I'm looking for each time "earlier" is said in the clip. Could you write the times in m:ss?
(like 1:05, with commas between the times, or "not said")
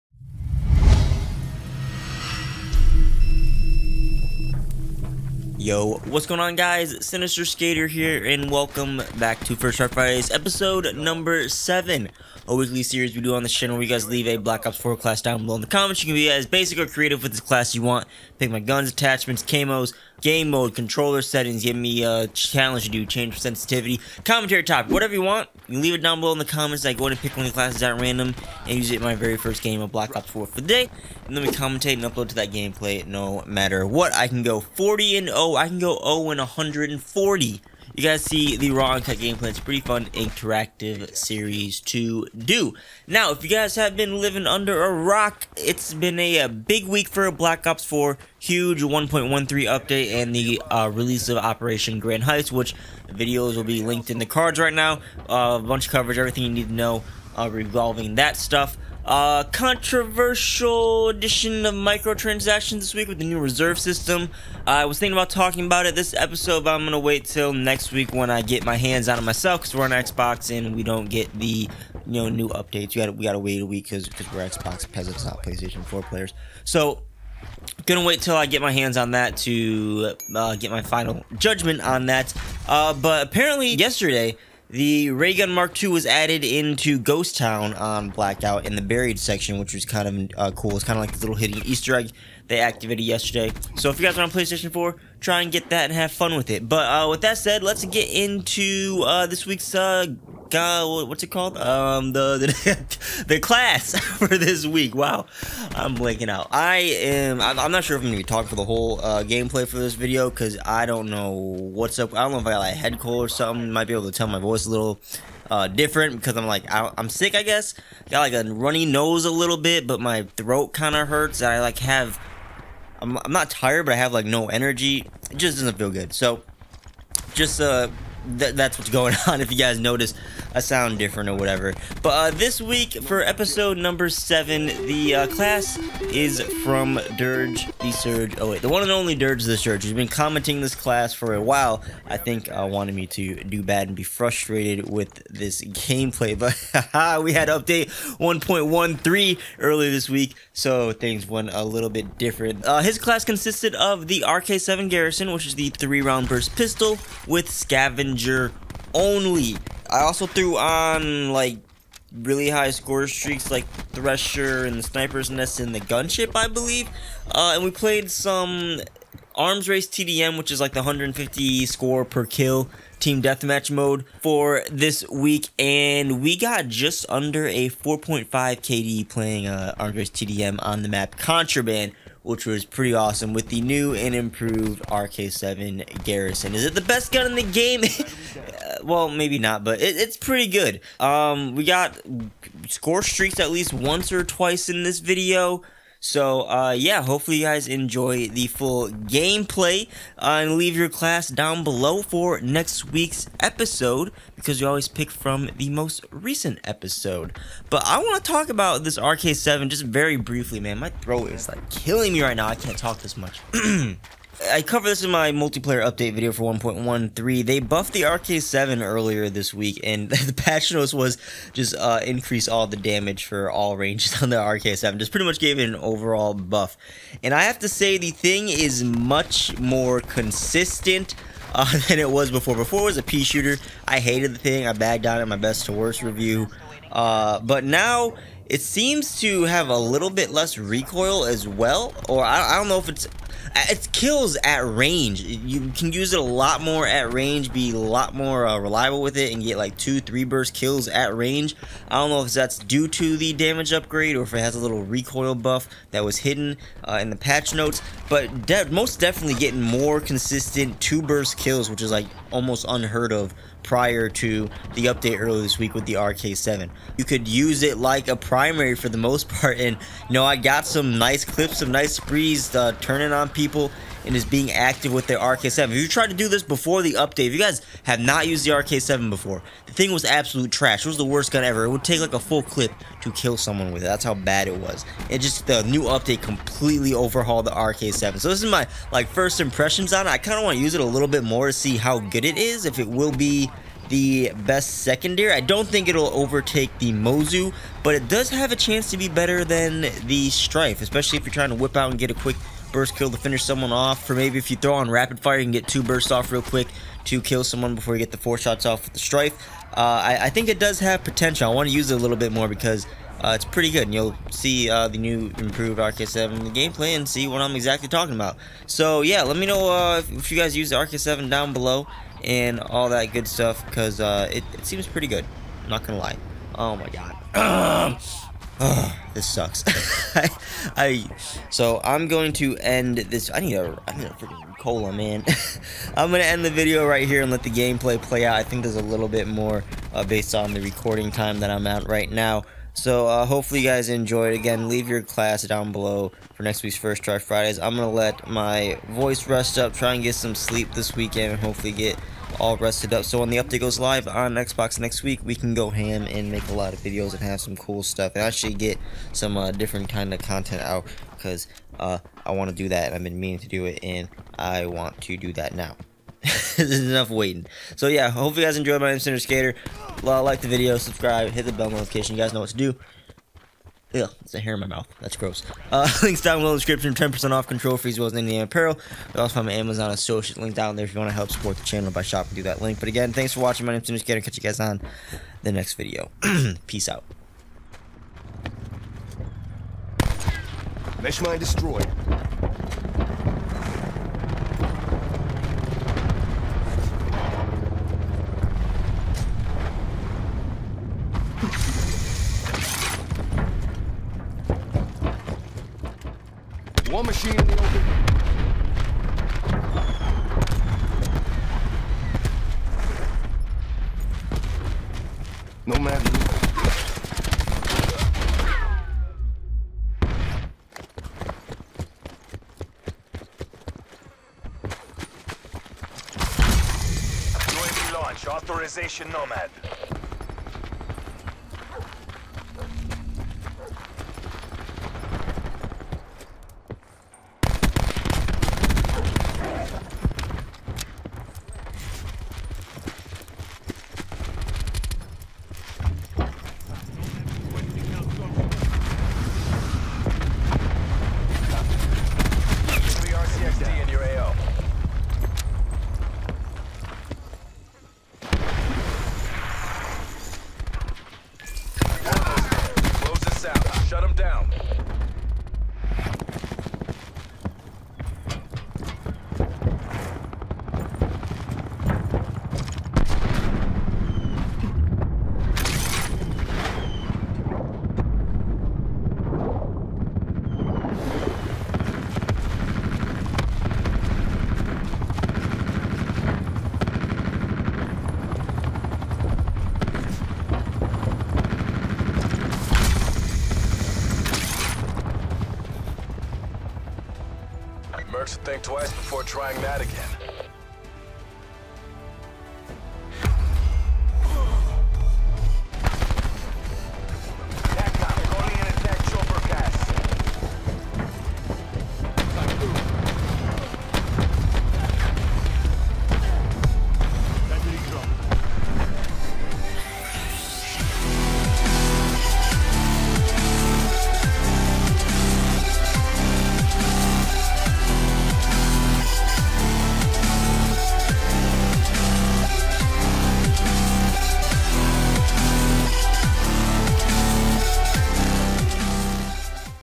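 2:29, 3:38, 4:25.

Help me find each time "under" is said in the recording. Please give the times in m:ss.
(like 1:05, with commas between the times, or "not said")
0:44, 2:57.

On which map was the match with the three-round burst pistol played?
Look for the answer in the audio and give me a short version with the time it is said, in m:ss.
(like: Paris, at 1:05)
Contraband, at 3:01.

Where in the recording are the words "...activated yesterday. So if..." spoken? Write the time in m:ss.
1:32.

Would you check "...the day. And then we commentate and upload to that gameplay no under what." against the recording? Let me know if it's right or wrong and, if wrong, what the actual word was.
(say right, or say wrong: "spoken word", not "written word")
wrong: "matter", not "under".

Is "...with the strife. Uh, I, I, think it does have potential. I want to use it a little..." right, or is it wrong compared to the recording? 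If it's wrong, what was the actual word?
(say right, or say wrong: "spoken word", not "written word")
right.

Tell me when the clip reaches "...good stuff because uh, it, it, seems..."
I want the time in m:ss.
5:23.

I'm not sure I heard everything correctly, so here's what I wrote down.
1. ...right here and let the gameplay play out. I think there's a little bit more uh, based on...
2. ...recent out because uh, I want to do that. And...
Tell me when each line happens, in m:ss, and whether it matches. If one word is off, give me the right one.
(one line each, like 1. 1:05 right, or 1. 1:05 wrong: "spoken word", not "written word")
1. 5:36 right
2. 6:00 wrong: "content", not "recent".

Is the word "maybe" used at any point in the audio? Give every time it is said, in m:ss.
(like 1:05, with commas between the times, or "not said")
3:09, 5:04.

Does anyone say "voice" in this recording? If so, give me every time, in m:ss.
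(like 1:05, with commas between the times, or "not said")
1:54, 5:48.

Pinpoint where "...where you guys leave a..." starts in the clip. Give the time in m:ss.
0:13.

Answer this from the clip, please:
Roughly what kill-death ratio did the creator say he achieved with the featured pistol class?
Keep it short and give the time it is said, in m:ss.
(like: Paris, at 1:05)
4.5, at 2:57.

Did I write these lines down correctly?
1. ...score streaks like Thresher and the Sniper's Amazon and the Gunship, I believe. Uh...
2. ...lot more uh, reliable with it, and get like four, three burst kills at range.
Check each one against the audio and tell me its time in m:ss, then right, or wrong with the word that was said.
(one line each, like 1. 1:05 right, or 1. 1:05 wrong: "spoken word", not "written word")
1. 2:42 wrong: "Nest", not "Amazon"
2. 4:07 wrong: "two", not "four".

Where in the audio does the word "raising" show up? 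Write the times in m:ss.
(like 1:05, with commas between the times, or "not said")
not said.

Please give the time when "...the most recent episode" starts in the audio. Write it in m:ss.
3:25.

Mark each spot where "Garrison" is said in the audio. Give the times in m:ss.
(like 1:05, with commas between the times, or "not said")
2:34, 3:06.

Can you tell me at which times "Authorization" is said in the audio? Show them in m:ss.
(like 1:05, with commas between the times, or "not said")
7:08.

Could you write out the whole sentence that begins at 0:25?
You leave it down below in the comments.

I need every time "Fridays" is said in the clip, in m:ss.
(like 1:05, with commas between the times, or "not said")
0:09, 5:47.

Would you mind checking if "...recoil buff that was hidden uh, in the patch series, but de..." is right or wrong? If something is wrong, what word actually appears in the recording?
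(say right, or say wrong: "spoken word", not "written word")
wrong: "notes", not "series".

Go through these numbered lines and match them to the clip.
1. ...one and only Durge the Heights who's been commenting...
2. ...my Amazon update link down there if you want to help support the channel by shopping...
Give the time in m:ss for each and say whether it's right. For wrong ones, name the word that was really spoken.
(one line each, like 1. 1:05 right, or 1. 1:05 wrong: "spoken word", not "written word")
1. 2:18 wrong: "Surge", not "Heights"
2. 6:19 wrong: "associate", not "update".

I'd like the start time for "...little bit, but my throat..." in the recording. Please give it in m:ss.
1:59.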